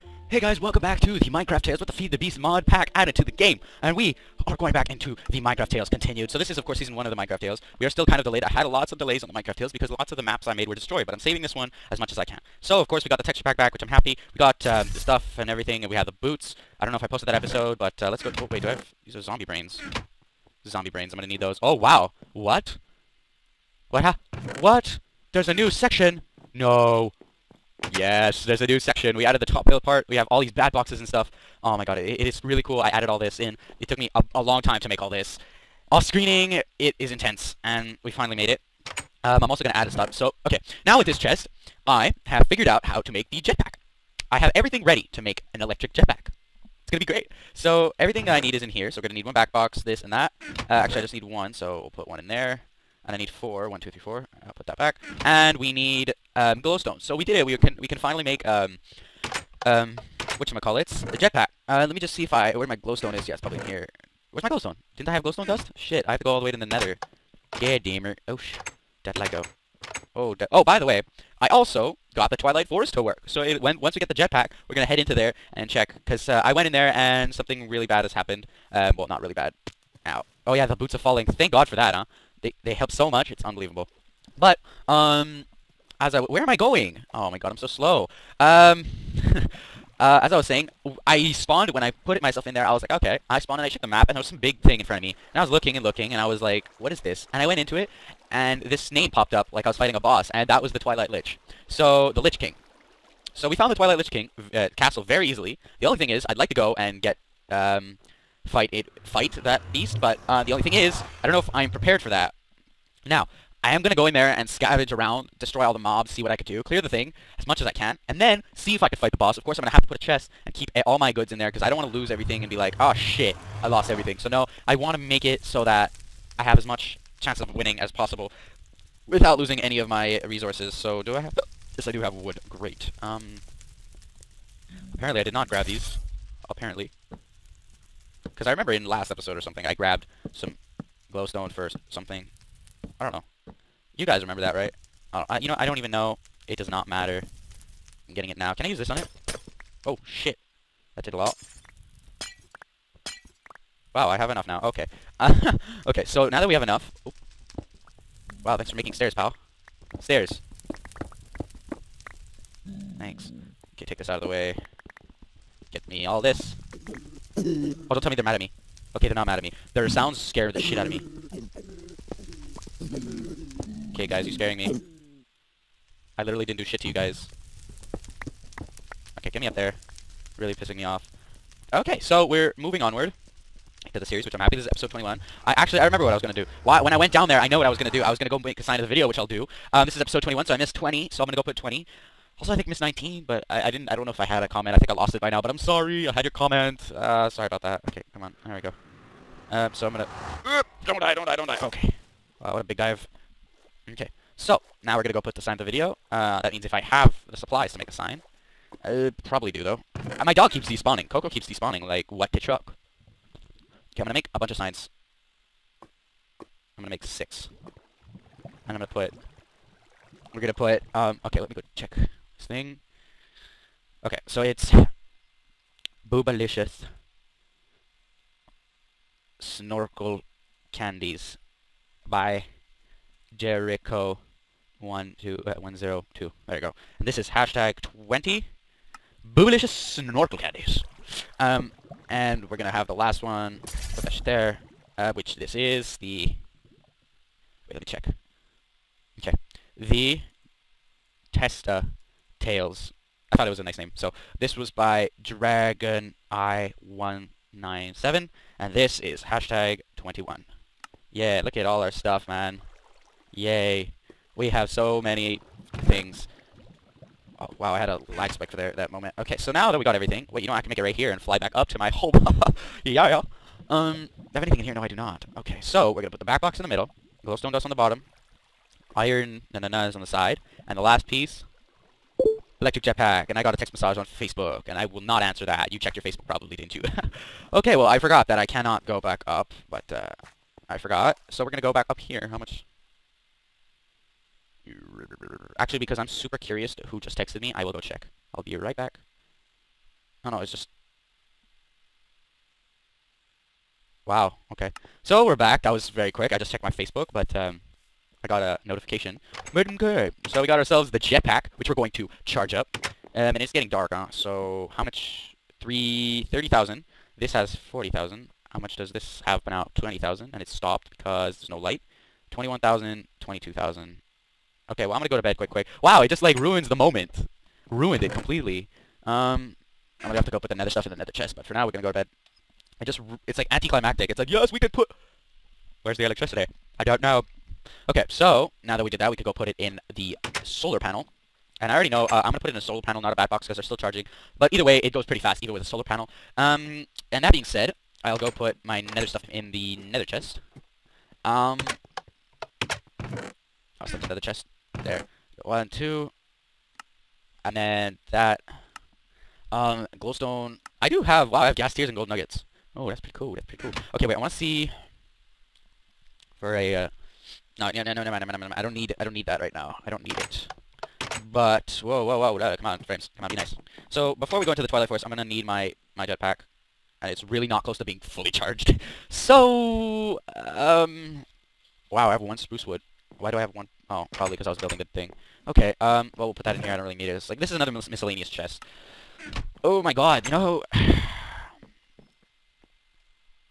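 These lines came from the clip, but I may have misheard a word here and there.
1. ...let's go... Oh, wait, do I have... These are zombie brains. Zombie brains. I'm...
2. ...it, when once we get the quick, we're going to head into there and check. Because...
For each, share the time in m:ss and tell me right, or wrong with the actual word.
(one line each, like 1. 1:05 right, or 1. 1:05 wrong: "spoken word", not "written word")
1. 0:18 right
2. 1:13 wrong: "jetpack", not "quick".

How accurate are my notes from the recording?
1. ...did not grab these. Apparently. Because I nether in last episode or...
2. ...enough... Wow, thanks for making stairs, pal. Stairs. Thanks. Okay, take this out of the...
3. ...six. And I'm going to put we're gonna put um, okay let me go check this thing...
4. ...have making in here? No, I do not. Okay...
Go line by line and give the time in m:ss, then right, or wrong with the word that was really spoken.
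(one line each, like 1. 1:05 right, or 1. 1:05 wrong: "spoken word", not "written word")
1. 2:15 wrong: "remember", not "nether"
2. 2:36 right
3. 3:37 right
4. 4:34 wrong: "anything", not "making".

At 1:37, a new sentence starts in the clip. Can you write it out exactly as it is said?
And I went into it, and this name popped up like I was fighting a boss, and that was the Twilight Lich.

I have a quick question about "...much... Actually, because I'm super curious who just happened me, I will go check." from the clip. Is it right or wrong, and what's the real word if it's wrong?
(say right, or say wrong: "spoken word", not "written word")
wrong: "texted", not "happened".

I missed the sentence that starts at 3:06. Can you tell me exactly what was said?
Why, when I went down there, I know what I was going to do.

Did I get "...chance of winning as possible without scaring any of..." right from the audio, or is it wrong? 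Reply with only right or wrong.
wrong.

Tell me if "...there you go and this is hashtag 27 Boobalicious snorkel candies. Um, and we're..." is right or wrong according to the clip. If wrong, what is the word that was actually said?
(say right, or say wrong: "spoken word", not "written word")
wrong: "20", not "27".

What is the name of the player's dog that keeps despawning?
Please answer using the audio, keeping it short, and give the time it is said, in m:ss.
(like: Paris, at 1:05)
Coco, at 3:31.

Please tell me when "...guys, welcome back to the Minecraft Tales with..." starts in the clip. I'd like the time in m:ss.
0:00.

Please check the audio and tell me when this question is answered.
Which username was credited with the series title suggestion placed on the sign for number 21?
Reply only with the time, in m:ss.
4:15.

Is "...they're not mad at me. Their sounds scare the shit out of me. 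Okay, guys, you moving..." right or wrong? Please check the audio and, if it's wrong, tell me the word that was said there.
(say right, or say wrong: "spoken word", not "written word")
wrong: "scaring", not "moving".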